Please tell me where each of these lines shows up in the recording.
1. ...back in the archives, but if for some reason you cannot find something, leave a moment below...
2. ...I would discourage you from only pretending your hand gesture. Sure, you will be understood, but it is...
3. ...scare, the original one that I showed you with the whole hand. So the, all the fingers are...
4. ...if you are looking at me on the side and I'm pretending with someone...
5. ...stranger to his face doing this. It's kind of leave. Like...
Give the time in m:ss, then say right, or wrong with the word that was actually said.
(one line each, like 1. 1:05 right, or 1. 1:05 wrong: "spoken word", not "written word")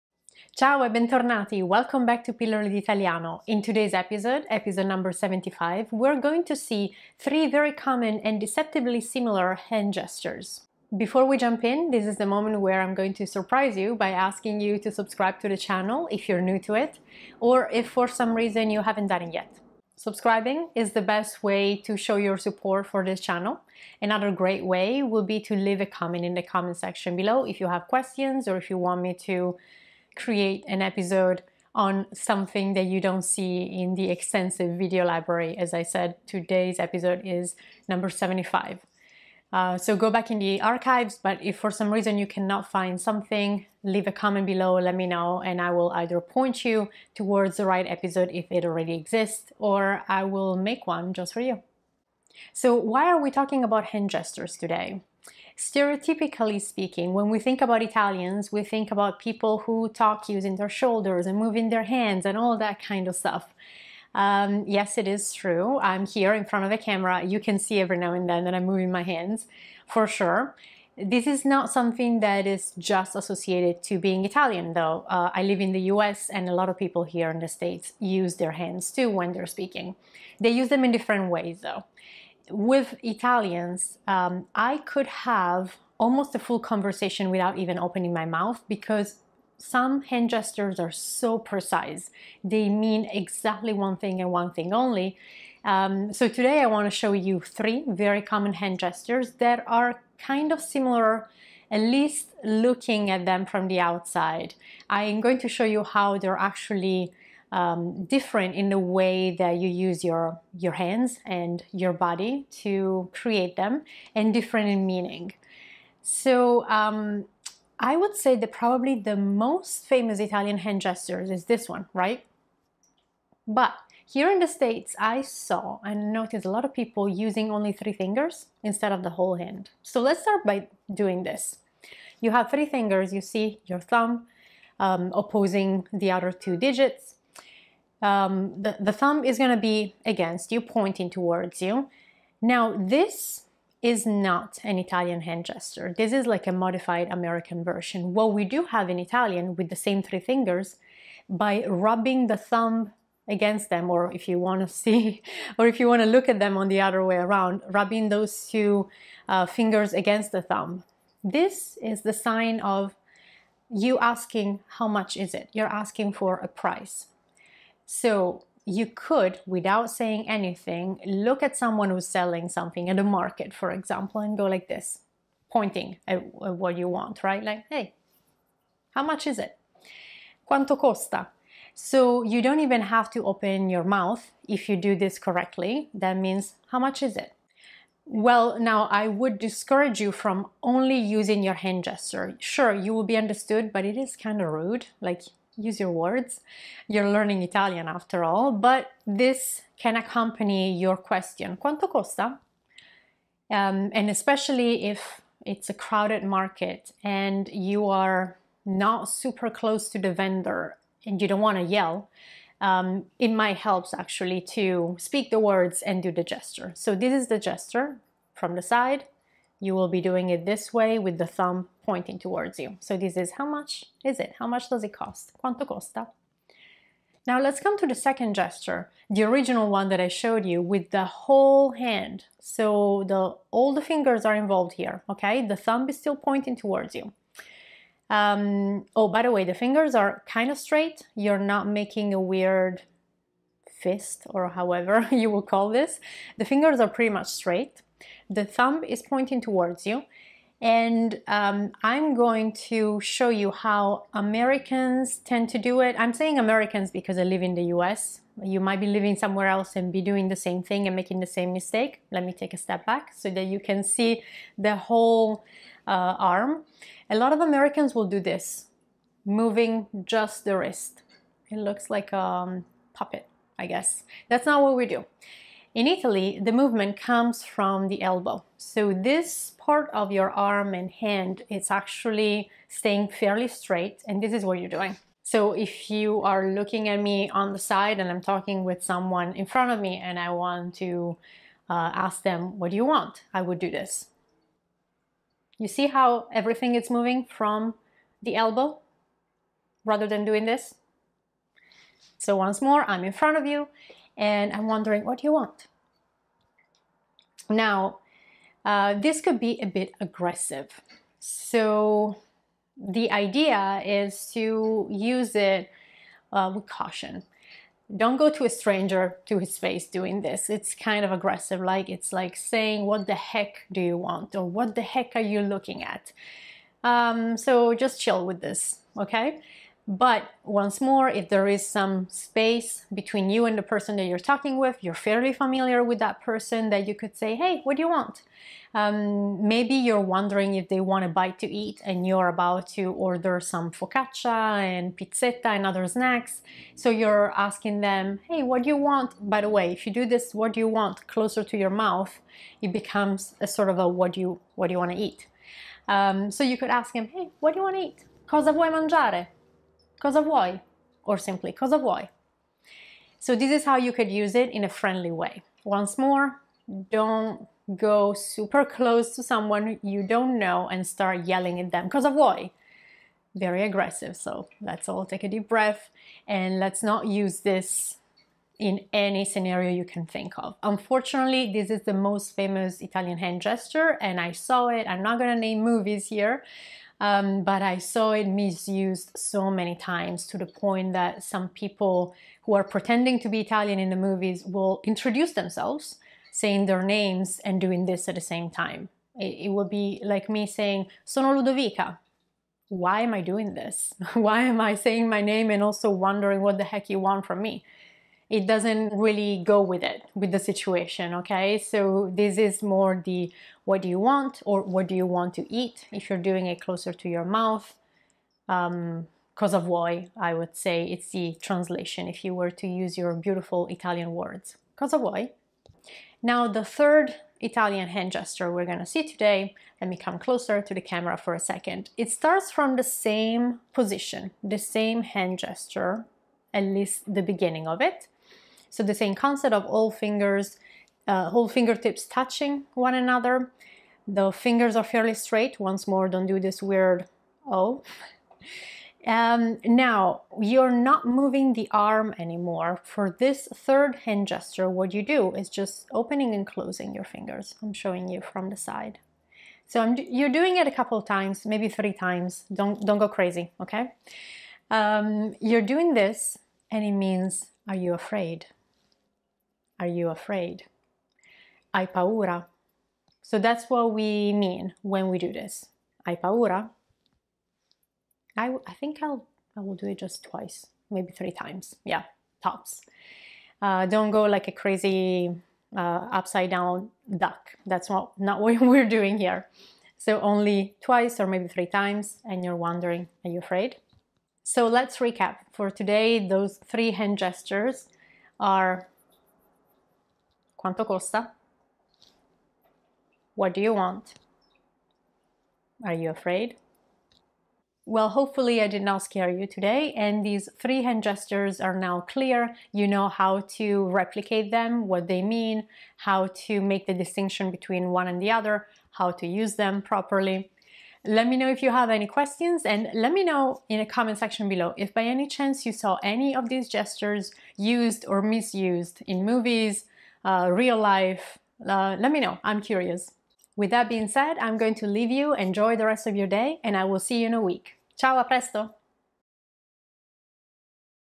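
1. 0:40 wrong: "comment", not "moment"
2. 3:08 wrong: "using", not "pretending"
3. 3:48 wrong: "gesture", not "scare"
4. 4:45 wrong: "talking", not "pretending"
5. 5:18 wrong: "aggressive", not "leave".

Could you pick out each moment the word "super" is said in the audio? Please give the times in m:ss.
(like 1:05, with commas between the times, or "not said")
3:29, 6:08.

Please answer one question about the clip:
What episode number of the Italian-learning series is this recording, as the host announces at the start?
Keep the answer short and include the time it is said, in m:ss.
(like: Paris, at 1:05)
75, at 0:04.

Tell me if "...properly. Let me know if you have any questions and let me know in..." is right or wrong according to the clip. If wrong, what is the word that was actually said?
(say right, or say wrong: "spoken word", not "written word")
right.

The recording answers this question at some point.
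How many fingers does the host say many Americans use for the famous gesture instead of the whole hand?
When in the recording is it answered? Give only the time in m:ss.
2:07.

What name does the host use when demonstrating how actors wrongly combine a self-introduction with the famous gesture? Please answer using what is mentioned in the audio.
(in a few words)
Ludovica.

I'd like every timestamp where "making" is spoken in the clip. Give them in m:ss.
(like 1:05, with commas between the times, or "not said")
4:01, 4:20.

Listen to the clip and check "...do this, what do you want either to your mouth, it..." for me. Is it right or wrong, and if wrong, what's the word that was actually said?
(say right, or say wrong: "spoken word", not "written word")
wrong: "closer", not "either".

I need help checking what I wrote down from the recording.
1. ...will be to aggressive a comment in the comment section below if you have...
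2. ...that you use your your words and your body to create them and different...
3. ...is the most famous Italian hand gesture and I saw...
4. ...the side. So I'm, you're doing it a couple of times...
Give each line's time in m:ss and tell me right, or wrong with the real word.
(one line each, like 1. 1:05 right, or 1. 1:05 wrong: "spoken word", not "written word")
1. 0:25 wrong: "leave", not "aggressive"
2. 1:49 wrong: "hands", not "words"
3. 6:21 right
4. 7:38 right.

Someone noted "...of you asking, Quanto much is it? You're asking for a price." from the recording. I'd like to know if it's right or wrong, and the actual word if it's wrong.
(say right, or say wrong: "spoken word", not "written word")
wrong: "How", not "Quanto".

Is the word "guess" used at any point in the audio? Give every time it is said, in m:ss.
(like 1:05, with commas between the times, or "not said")
4:33.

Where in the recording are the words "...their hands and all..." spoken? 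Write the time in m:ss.
1:01.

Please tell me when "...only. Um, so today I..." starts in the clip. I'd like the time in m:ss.
1:34.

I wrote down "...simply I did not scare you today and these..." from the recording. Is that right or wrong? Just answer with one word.
wrong.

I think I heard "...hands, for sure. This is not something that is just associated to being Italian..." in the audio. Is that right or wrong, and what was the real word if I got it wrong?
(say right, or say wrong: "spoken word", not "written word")
right.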